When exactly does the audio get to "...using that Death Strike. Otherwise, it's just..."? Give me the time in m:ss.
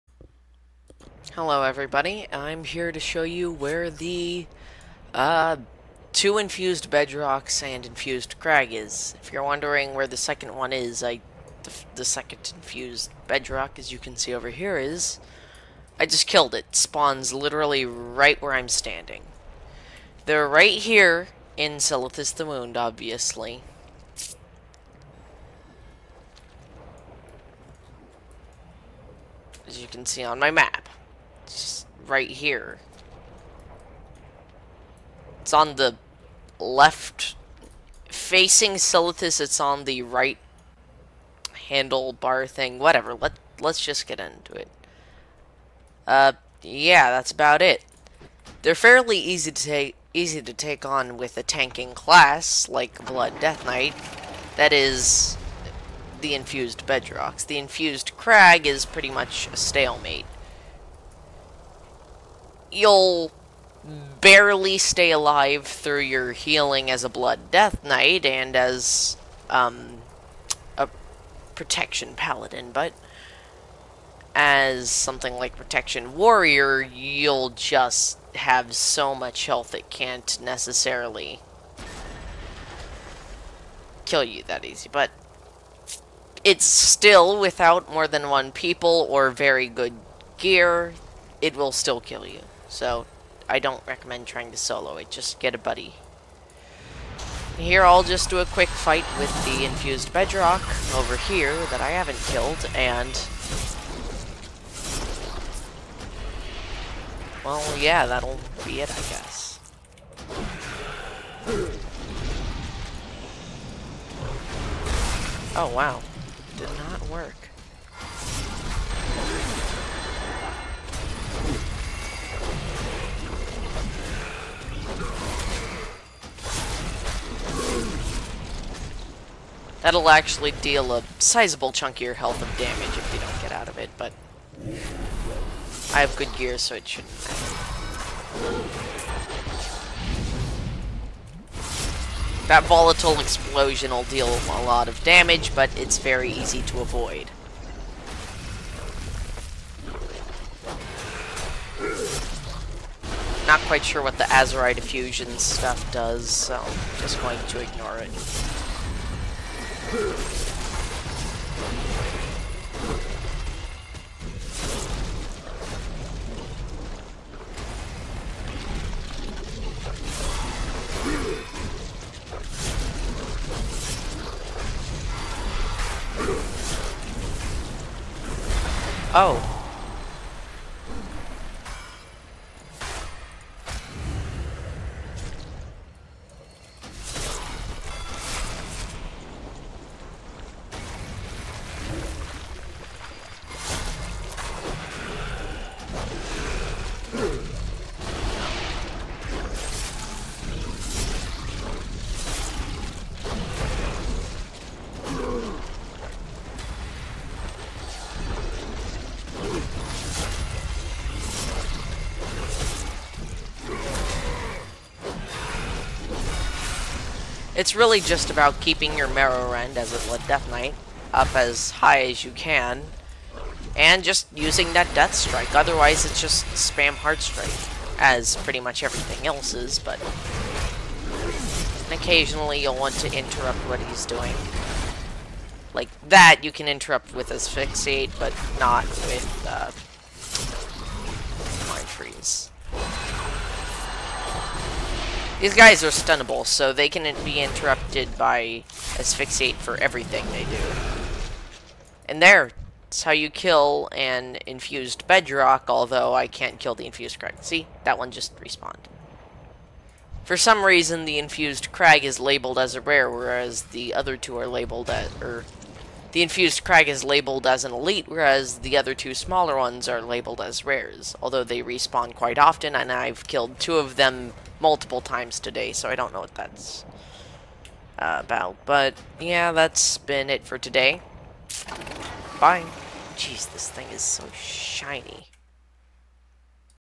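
3:44.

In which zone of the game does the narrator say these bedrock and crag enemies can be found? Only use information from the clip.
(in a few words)
Silithus the Wound.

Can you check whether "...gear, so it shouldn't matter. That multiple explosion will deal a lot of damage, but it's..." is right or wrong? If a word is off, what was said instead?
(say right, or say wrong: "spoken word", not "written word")
wrong: "volatile", not "multiple".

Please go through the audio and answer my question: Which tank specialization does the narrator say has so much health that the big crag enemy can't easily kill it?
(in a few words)
Protection Warrior.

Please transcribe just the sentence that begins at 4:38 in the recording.
But, yeah, that's been it for today.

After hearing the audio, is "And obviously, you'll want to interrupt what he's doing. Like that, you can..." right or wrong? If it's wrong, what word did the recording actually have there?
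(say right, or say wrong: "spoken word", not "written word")
wrong: "occasionally", not "obviously".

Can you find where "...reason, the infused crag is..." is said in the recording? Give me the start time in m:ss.
4:20.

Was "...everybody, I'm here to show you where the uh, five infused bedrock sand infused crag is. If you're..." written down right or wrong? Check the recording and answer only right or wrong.
wrong.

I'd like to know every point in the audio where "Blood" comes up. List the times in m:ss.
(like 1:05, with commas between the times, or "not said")
0:53, 1:07.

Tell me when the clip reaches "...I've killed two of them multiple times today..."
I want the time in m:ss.
4:32.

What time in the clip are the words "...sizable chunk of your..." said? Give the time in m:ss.
2:11.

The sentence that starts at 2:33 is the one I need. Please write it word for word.
Not quite sure what the Azerite Effusion stuff does, so I'm just going to ignore it.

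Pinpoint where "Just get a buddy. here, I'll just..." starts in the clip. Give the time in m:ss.
1:35.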